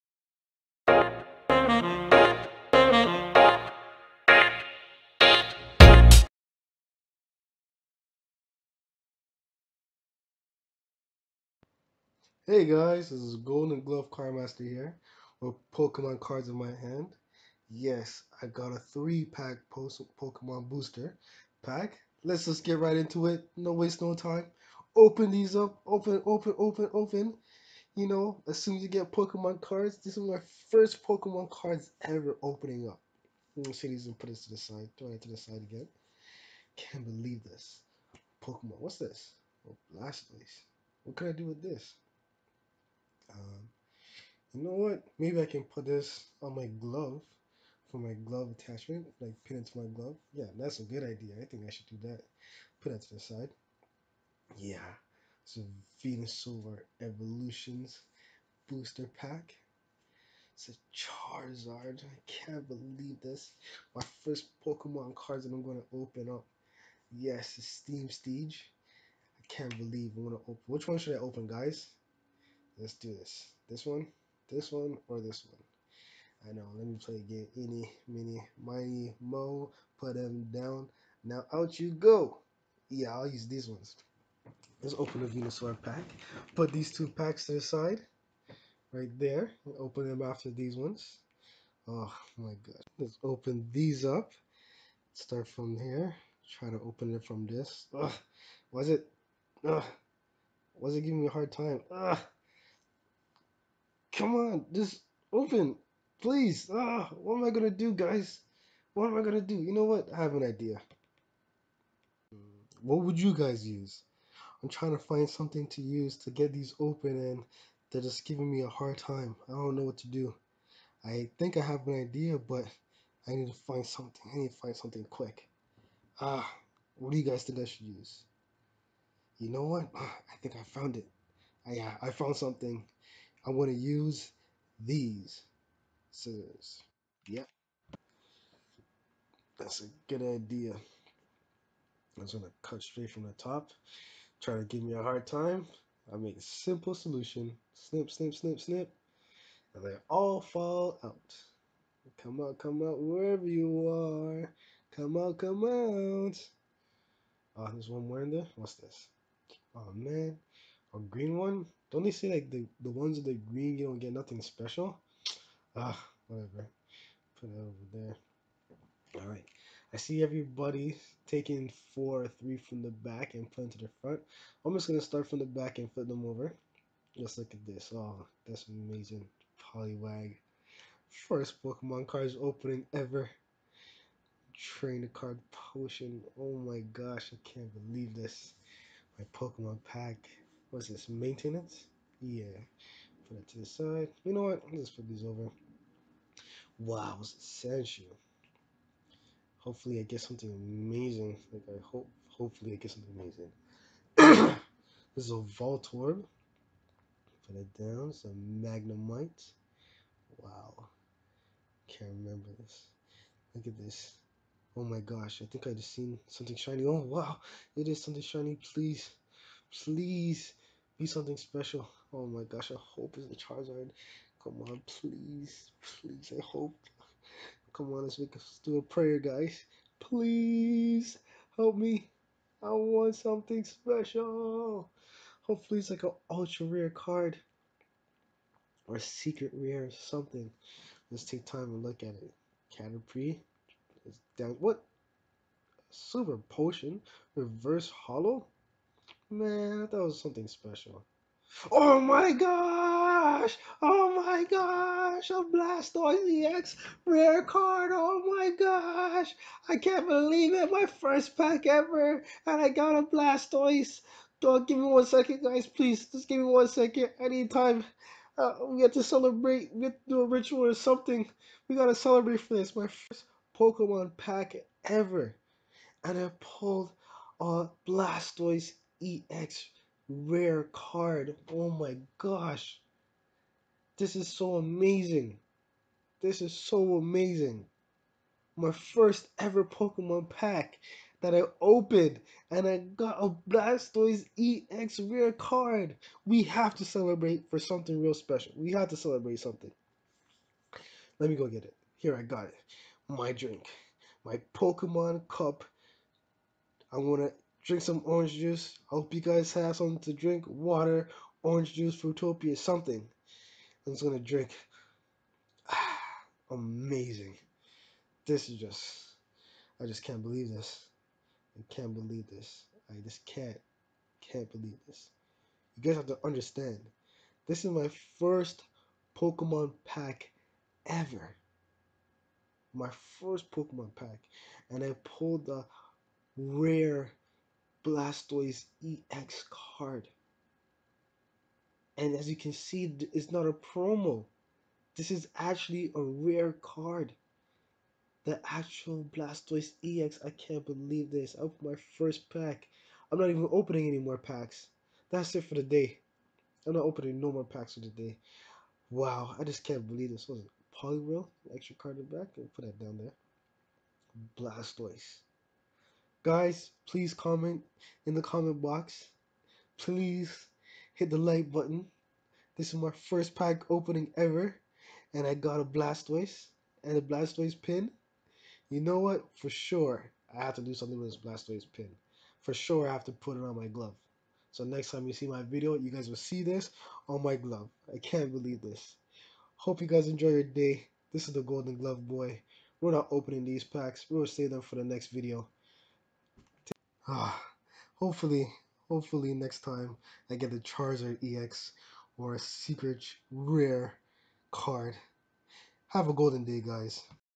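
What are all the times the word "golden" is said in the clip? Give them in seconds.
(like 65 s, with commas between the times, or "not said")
13 s, 391 s, 406 s.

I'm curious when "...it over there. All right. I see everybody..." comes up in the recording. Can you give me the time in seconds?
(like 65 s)
167 s.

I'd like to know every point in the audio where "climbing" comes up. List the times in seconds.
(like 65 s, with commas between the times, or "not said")
not said.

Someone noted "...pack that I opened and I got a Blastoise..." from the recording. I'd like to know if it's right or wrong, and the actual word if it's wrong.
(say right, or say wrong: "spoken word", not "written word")
right.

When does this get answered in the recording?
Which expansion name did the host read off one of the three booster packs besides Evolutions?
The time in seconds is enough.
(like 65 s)
67 s.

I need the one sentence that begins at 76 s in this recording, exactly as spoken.
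I know, let me play again.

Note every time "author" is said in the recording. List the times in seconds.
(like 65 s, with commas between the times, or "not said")
not said.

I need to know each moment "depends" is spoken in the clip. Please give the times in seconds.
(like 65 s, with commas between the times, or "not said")
not said.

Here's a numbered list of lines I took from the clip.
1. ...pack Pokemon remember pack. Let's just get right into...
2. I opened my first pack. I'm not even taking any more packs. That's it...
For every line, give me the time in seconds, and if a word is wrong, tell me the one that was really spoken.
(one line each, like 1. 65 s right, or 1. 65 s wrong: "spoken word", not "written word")
1. 19 s wrong: "booster", not "remember"
2. 351 s wrong: "opening", not "taking".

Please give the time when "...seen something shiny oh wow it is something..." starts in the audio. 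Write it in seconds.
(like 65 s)
215 s.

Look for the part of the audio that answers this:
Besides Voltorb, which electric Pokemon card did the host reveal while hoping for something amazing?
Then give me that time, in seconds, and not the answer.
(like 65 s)
208 s.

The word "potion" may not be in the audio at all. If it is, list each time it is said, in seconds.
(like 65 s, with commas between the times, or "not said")
185 s, 246 s.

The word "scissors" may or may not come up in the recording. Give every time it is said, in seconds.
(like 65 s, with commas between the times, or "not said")
136 s.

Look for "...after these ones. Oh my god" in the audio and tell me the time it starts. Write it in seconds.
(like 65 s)
90 s.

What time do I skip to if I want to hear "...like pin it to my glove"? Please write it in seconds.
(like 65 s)
49 s.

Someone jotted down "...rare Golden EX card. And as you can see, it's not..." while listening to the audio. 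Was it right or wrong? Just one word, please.
wrong.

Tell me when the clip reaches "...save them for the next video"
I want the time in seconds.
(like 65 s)
394 s.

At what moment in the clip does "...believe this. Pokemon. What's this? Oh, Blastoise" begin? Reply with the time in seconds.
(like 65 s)
37 s.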